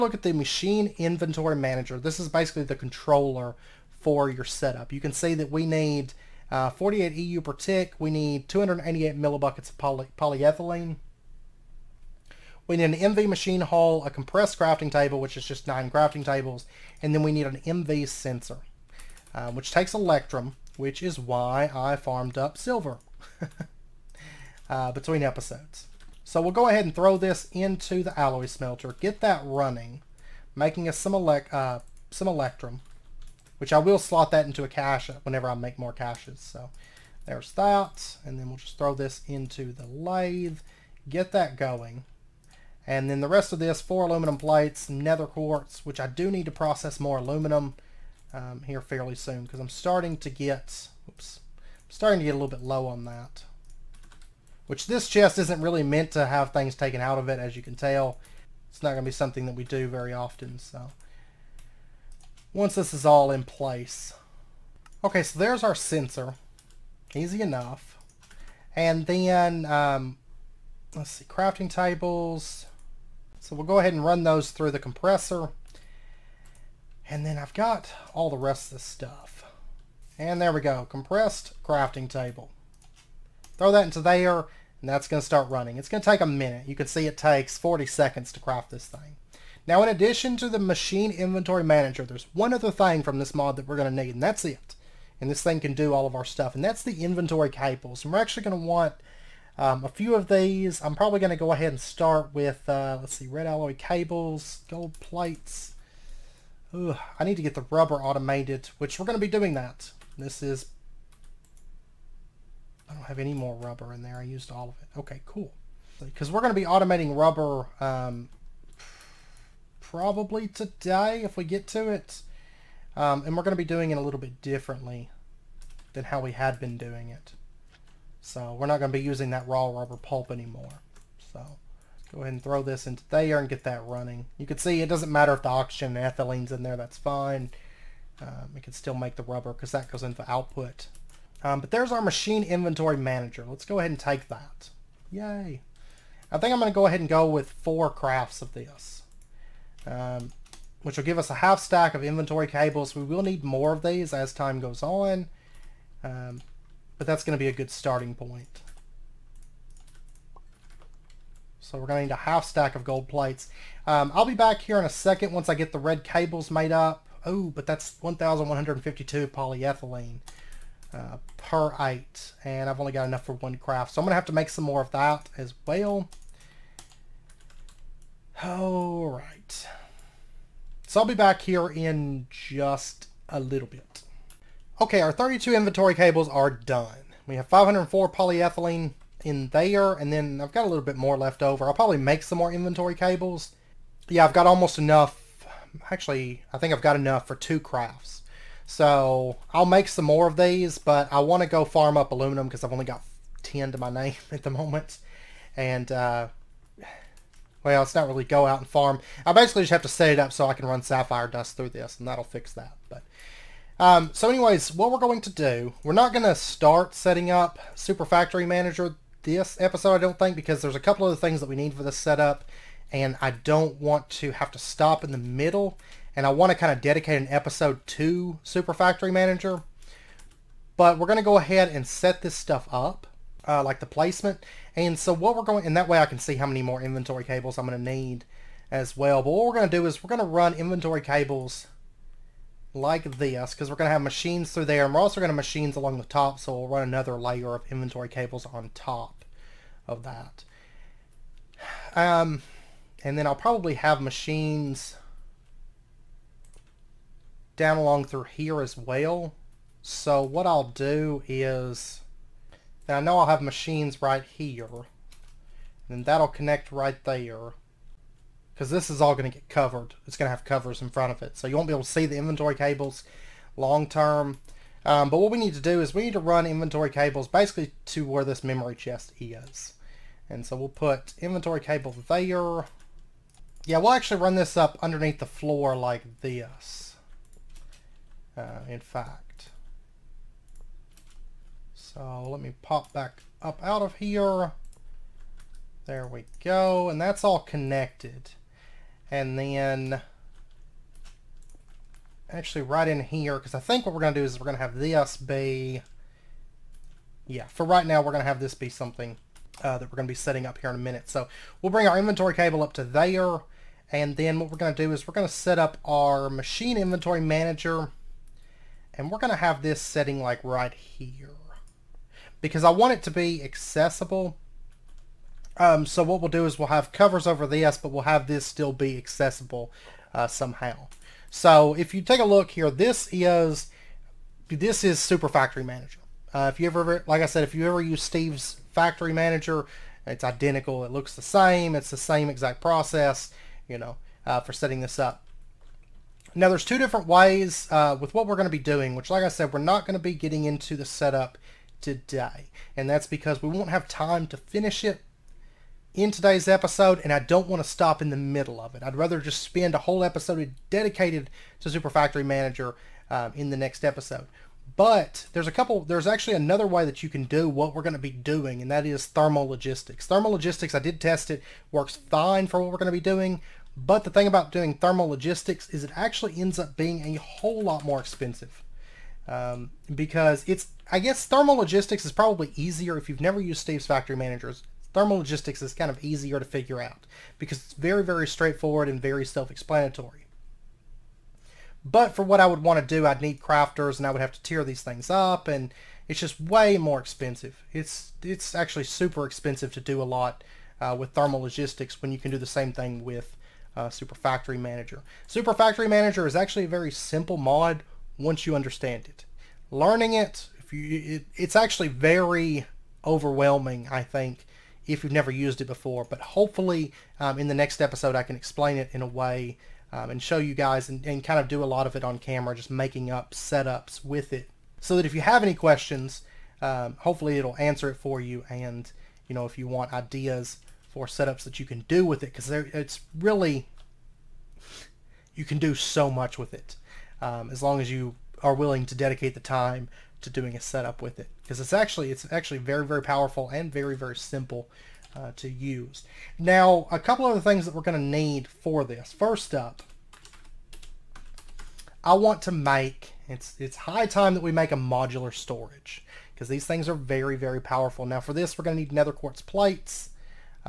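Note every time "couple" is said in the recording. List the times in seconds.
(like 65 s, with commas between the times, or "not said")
220 s, 365 s, 446 s.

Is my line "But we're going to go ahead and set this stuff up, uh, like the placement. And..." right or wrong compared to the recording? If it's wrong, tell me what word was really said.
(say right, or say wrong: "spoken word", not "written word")
right.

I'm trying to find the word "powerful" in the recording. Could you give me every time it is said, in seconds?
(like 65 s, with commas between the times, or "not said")
443 s, 457 s.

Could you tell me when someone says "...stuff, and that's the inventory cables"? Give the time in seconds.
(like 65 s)
96 s.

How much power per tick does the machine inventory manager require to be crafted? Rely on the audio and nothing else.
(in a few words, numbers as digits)
48 EU.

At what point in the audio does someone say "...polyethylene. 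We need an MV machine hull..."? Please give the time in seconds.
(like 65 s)
10 s.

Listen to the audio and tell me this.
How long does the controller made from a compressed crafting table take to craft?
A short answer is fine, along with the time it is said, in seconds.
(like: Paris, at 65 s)
40 seconds, at 87 s.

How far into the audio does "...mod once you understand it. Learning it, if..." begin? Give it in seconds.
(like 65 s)
407 s.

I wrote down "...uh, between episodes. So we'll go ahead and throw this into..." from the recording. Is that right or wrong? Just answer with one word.
right.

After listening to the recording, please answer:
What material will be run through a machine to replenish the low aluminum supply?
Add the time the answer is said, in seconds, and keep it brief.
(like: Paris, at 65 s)
Sapphire dust, at 210 s.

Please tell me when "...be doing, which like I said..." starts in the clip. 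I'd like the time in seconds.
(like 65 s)
348 s.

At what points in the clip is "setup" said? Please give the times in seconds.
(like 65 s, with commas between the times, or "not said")
4 s, 221 s, 350 s, 423 s, 431 s, 440 s.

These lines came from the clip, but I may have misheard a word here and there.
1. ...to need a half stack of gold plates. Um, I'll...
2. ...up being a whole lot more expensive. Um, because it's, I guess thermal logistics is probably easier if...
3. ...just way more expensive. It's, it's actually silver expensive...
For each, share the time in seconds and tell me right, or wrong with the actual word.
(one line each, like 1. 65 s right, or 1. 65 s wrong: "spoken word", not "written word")
1. 161 s right
2. 376 s right
3. 396 s wrong: "super", not "silver".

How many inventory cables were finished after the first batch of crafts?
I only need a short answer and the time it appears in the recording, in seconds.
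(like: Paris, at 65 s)
32, at 185 s.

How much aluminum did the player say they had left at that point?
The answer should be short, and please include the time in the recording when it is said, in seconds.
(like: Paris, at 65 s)
10, at 203 s.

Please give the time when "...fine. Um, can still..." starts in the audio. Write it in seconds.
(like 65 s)
136 s.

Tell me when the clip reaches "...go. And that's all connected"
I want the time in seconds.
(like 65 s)
296 s.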